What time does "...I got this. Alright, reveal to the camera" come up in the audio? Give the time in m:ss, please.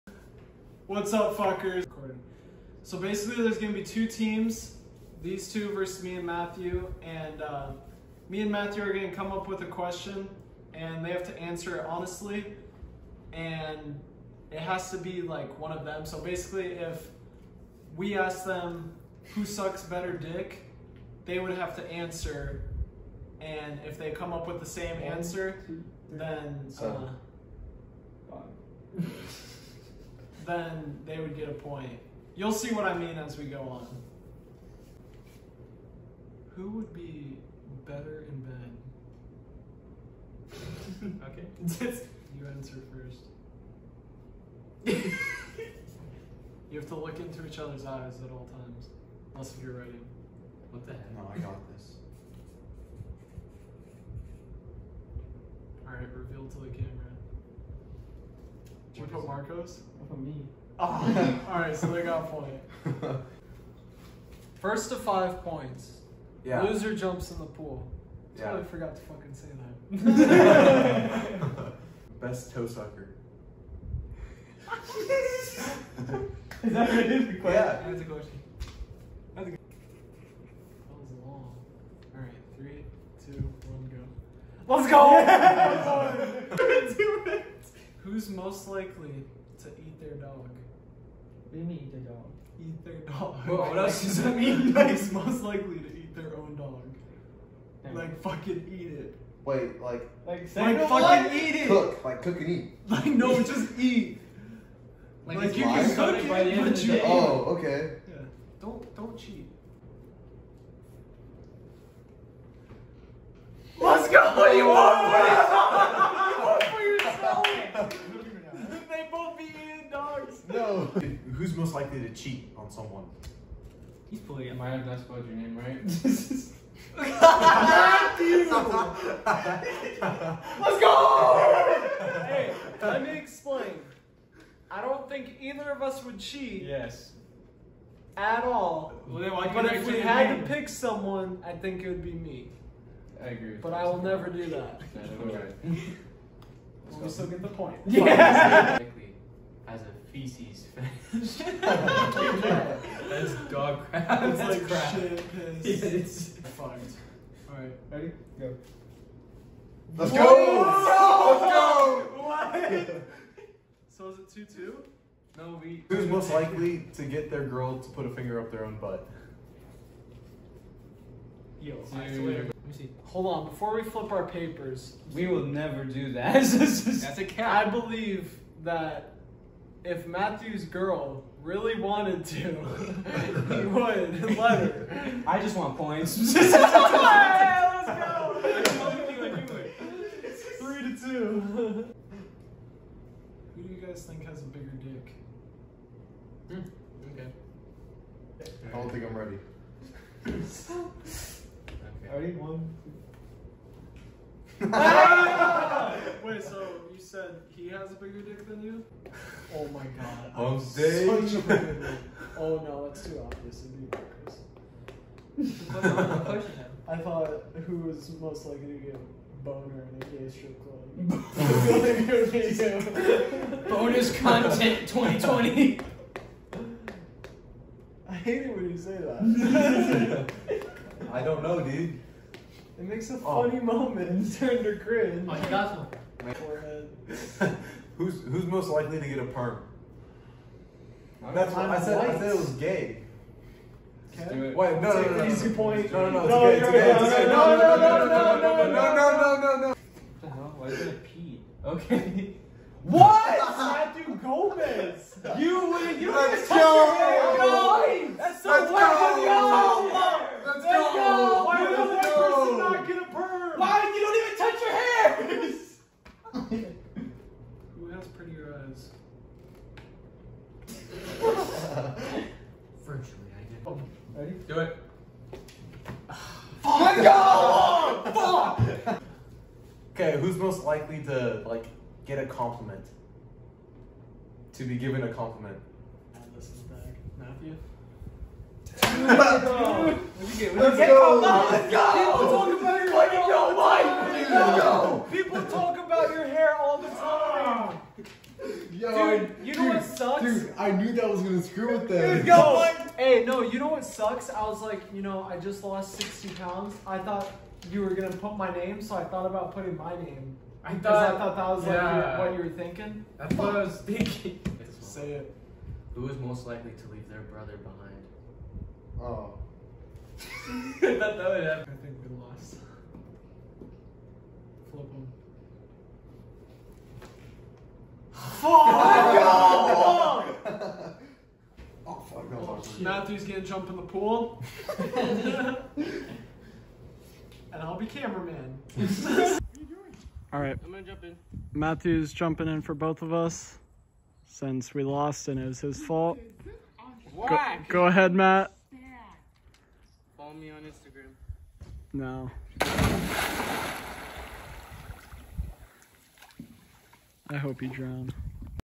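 0:51.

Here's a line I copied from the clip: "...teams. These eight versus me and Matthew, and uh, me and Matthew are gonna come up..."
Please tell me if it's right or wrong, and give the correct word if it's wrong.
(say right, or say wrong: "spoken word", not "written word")
wrong: "two", not "eight".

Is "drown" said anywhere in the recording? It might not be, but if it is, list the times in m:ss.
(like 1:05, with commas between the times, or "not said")
5:57.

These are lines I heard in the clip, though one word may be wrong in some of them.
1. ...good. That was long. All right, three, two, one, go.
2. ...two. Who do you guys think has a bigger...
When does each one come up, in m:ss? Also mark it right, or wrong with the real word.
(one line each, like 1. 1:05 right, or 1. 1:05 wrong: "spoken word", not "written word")
1. 1:19 right
2. 3:11 right.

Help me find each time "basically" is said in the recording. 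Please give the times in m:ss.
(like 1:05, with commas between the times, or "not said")
0:02, 0:16.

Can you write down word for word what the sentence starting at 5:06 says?
I thought you were gonna put my name, so I thought about putting my name.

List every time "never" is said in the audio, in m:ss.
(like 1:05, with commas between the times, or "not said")
2:24, 2:55.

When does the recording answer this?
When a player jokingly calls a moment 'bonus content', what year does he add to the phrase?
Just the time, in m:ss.
3:44.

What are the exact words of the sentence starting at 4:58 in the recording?
Yo, dude, you know dude, what sucks?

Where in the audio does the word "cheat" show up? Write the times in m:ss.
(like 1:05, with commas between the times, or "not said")
1:49, 2:02, 2:16.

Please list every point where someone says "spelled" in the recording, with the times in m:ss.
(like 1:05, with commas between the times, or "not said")
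2:04.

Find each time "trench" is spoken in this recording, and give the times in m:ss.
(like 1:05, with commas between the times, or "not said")
not said.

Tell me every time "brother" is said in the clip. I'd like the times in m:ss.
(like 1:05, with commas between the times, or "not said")
5:17.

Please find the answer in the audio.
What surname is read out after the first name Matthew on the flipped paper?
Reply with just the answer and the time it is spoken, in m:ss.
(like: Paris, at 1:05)
Gomez, at 4:14.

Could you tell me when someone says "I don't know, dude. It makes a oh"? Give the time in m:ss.
3:51.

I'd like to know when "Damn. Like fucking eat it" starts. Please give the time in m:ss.
1:37.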